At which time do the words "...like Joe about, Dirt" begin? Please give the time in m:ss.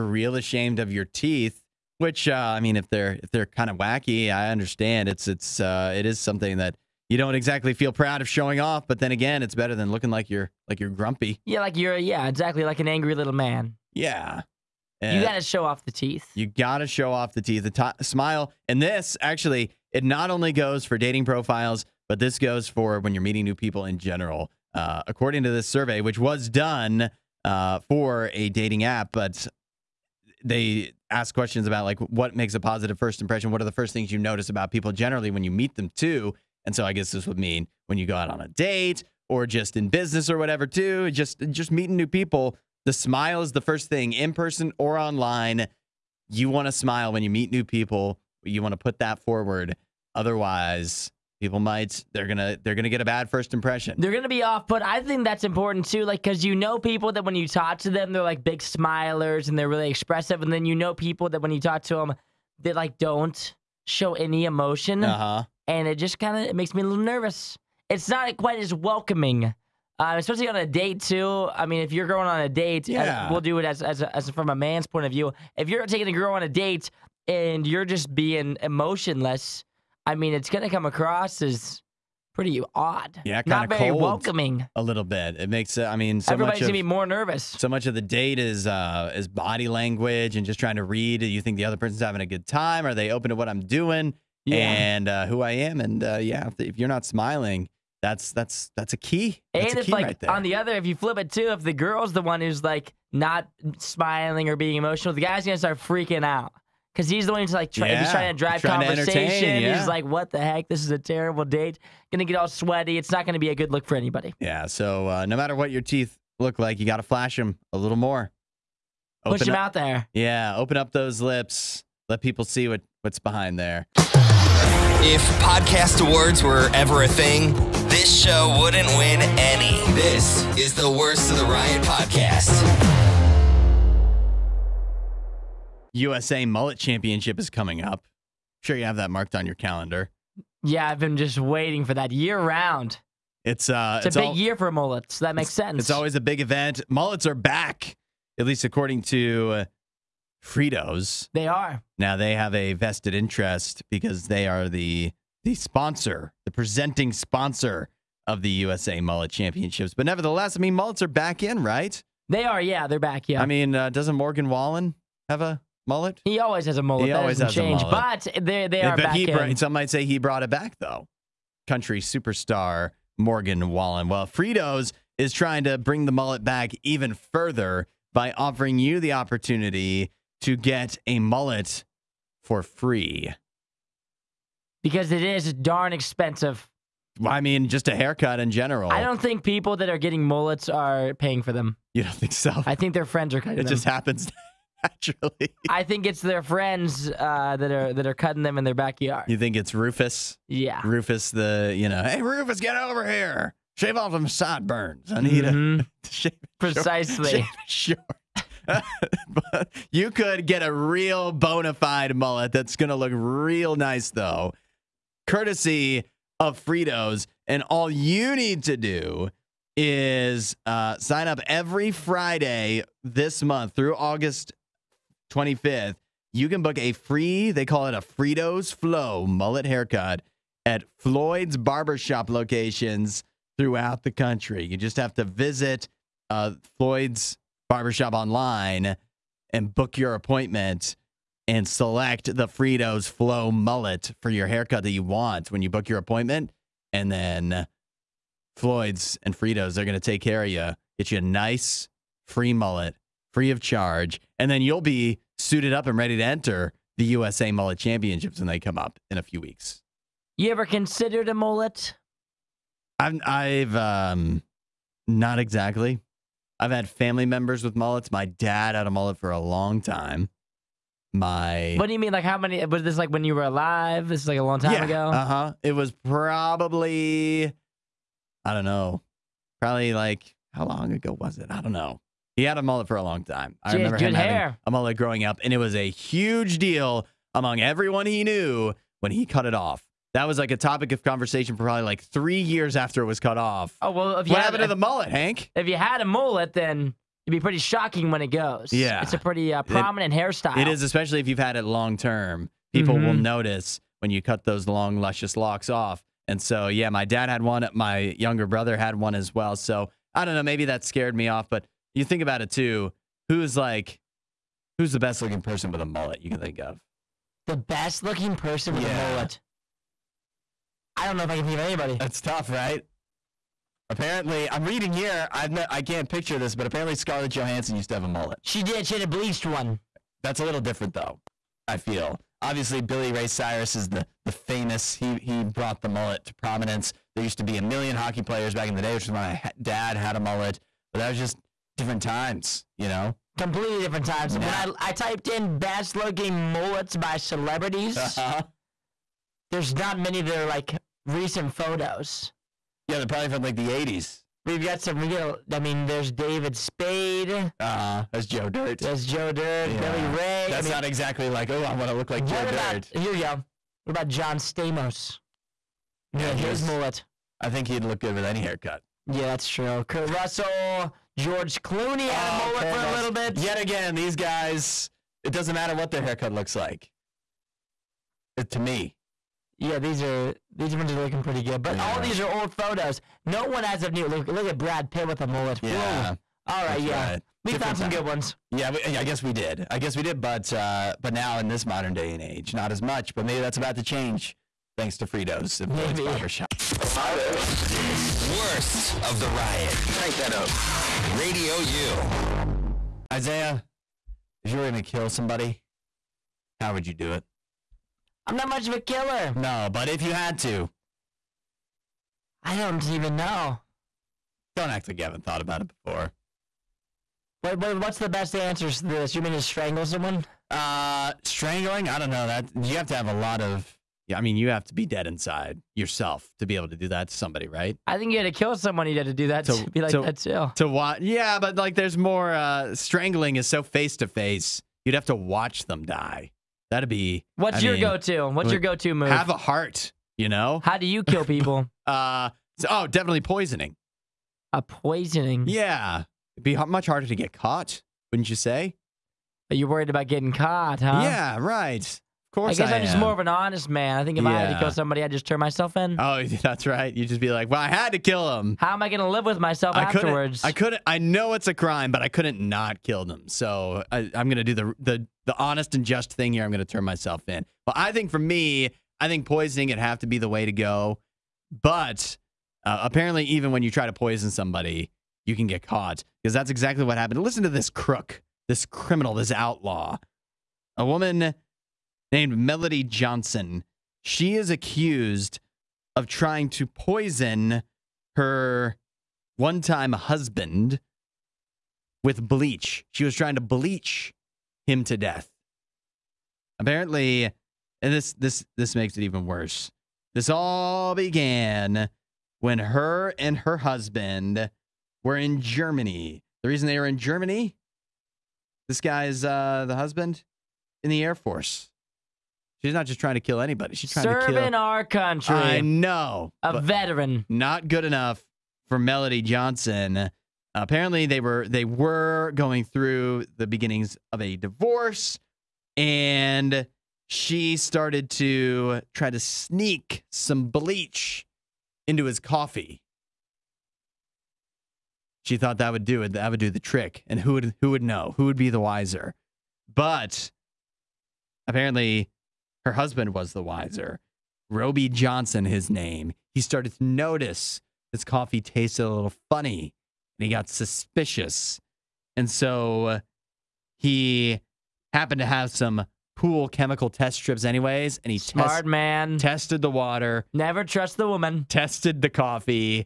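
6:02.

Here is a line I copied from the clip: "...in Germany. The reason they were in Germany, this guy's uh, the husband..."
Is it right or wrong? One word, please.
right.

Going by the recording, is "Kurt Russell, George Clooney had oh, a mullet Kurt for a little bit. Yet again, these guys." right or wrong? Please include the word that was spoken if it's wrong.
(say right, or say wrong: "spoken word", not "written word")
right.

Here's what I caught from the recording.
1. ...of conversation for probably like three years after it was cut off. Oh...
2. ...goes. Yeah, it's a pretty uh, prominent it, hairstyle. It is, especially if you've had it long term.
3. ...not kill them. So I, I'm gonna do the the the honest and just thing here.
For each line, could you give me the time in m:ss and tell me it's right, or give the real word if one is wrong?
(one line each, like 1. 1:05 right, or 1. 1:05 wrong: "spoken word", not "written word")
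1. 4:50 right
2. 4:58 right
3. 7:42 right.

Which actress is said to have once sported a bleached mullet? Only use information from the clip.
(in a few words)
Scarlett Johansson.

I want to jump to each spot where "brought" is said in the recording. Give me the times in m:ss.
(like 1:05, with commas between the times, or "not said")
2:50, 5:35.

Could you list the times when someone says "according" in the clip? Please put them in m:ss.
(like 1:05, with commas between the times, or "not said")
0:25, 2:28.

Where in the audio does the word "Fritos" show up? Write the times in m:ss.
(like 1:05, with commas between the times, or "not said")
2:30, 2:54, 3:36, 3:48, 4:02, 4:09, 6:35.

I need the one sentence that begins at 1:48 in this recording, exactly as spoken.
he's trying to drive trying conversation.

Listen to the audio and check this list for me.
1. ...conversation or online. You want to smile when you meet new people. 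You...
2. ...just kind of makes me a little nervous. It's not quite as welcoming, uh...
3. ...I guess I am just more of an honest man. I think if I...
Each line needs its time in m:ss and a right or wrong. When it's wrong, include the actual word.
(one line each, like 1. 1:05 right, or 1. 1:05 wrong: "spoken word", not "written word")
1. 0:44 wrong: "person", not "conversation"
2. 1:05 right
3. 7:32 right.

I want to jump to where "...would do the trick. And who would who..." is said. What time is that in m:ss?
8:56.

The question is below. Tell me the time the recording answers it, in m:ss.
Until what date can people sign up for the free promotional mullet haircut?
3:43.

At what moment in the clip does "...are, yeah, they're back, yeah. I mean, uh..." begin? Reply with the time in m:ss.
2:42.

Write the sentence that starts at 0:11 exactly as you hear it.
Yeah, like you're yeah, exactly like an angry little man.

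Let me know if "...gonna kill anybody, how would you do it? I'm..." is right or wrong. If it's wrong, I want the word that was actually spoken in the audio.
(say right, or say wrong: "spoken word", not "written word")
wrong: "somebody", not "anybody".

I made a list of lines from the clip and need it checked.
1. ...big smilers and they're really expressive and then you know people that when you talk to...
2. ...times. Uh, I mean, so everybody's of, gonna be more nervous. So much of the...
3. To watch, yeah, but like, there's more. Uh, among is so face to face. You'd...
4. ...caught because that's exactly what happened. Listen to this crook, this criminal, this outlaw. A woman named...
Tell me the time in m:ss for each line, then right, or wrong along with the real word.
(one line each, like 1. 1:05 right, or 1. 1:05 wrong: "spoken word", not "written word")
1. 0:58 right
2. 1:25 wrong: "makes", not "times"
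3. 7:10 wrong: "strangling", not "among"
4. 7:55 right.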